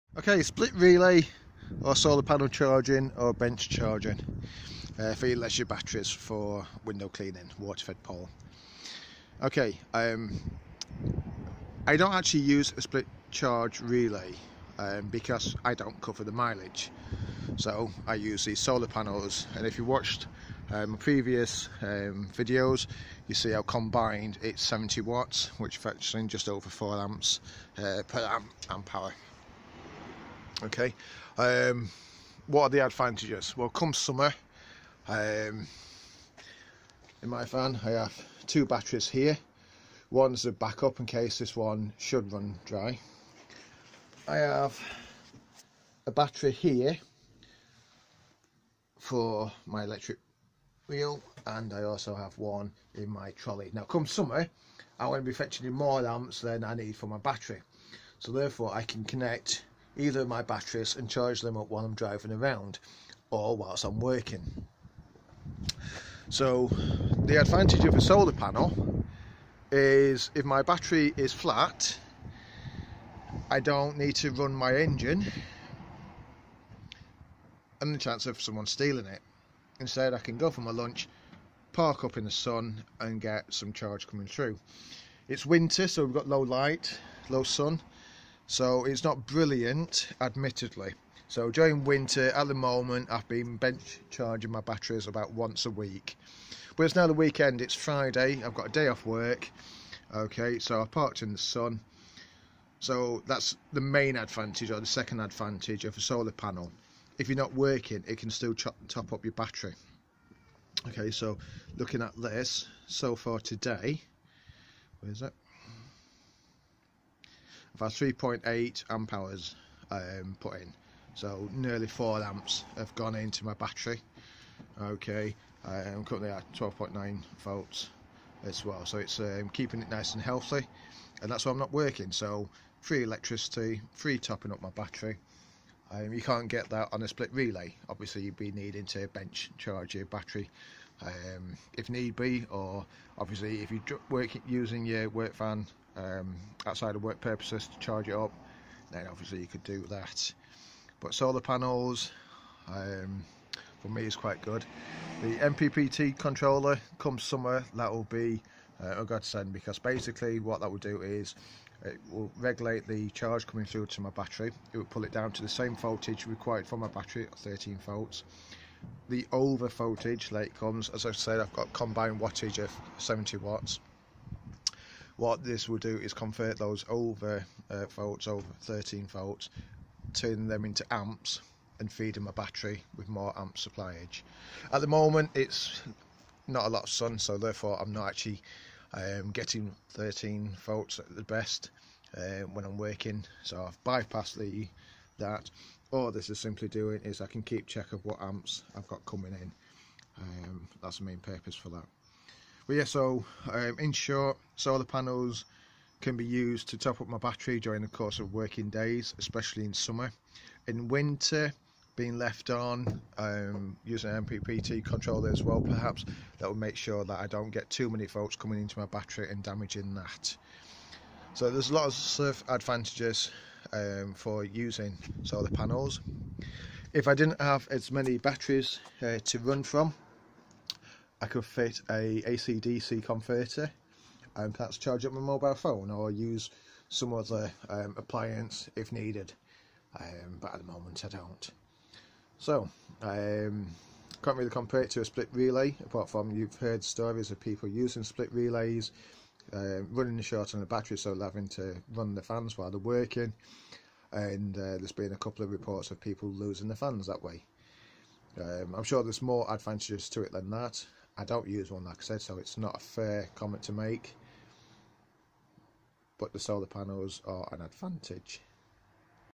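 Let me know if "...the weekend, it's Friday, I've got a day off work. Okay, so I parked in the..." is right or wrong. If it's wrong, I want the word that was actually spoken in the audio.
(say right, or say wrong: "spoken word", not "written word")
right.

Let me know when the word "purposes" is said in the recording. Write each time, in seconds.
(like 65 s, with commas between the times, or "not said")
147 s, 201 s.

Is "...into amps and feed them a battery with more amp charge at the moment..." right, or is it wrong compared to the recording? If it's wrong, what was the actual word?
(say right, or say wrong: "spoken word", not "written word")
wrong: "supplyage", not "charge".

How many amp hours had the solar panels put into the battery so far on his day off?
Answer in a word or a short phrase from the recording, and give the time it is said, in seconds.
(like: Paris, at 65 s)
3.8 amp hours, at 117 s.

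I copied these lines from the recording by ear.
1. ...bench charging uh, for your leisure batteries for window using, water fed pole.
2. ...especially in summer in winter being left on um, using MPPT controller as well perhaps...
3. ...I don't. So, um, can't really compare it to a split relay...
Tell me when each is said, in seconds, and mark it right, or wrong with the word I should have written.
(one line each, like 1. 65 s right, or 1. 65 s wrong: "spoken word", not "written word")
1. 3 s wrong: "cleaning", not "using"
2. 209 s right
3. 241 s right.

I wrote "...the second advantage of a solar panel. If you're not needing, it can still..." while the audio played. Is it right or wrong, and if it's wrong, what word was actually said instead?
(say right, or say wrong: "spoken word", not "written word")
wrong: "working", not "needing".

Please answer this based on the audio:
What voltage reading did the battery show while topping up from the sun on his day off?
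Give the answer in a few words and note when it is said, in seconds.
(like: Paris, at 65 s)
12.9 volts, at 126 s.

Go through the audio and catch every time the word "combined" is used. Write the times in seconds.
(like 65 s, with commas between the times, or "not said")
23 s, 171 s.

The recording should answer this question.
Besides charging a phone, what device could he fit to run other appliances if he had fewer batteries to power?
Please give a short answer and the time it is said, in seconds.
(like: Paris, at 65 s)
AC-DC converter, at 232 s.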